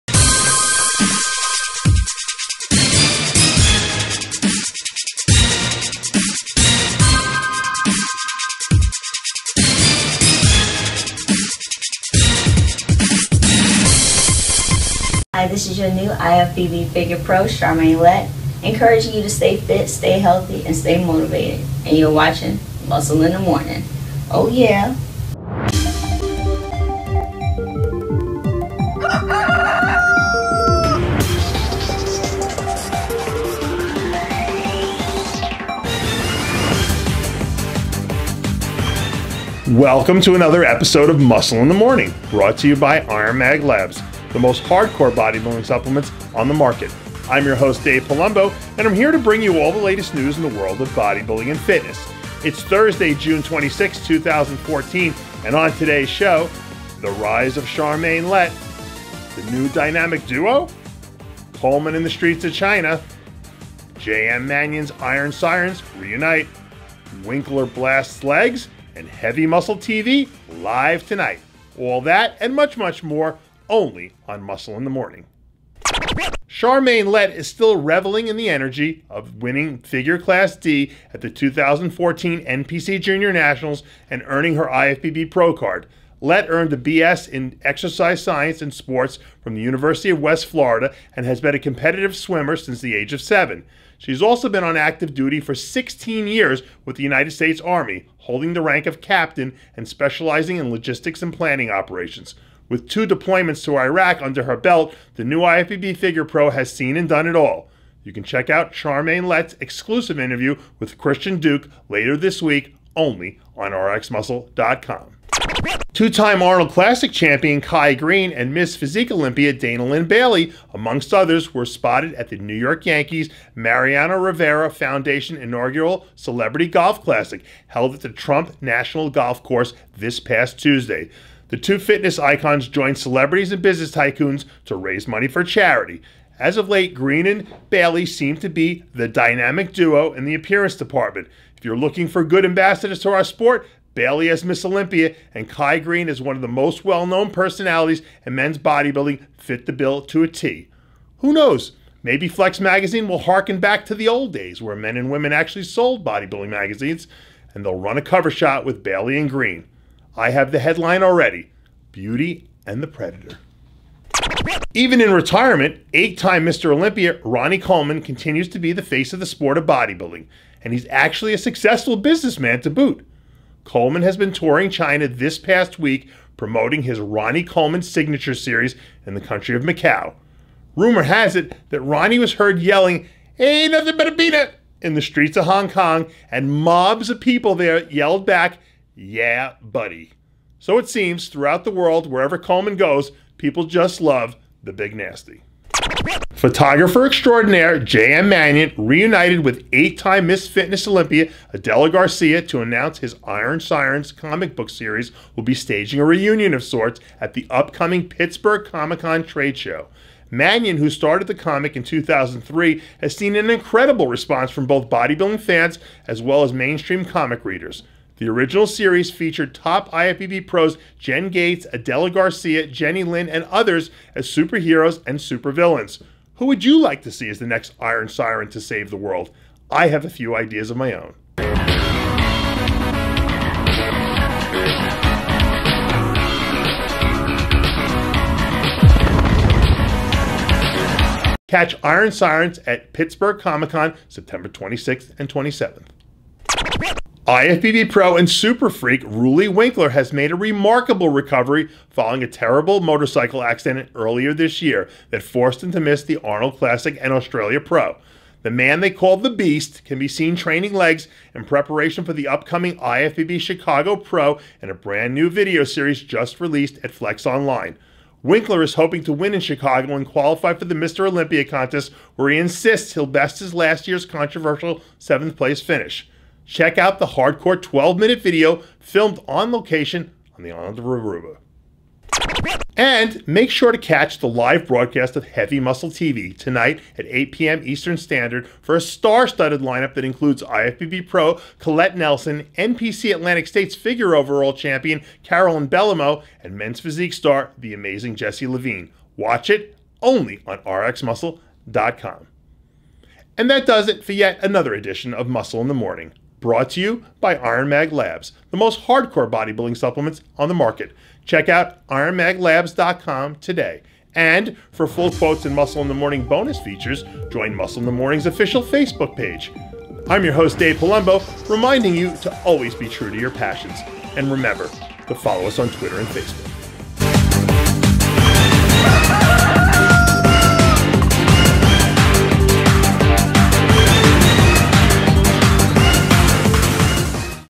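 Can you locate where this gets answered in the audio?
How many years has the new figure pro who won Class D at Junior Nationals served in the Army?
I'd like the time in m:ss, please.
1:35.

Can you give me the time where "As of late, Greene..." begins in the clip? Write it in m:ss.
2:16.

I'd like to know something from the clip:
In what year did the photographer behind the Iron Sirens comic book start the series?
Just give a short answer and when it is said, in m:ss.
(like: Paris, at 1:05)
2003, at 3:31.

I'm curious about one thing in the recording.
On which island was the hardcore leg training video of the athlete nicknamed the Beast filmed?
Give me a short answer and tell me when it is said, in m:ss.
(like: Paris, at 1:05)
Aruba, at 4:40.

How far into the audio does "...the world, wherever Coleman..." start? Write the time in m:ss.
3:11.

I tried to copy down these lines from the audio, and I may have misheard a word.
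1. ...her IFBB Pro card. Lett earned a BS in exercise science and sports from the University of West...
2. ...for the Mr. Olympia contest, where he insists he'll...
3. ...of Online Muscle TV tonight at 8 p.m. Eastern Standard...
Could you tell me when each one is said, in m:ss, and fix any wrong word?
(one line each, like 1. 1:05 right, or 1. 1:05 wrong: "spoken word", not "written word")
1. 1:24 right
2. 4:30 right
3. 4:45 wrong: "Heavy", not "Online".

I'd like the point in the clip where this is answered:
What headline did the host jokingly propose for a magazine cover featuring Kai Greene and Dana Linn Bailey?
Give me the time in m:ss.
2:41.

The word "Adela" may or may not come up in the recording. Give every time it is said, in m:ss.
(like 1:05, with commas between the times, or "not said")
3:21, 3:41.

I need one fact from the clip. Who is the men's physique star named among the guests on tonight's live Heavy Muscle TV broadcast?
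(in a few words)
Jesse Levine.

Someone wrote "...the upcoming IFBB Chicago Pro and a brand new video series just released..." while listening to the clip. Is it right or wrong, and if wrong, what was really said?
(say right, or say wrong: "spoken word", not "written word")
right.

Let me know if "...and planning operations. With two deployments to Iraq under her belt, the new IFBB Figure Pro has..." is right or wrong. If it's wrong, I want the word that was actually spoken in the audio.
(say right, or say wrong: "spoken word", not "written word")
right.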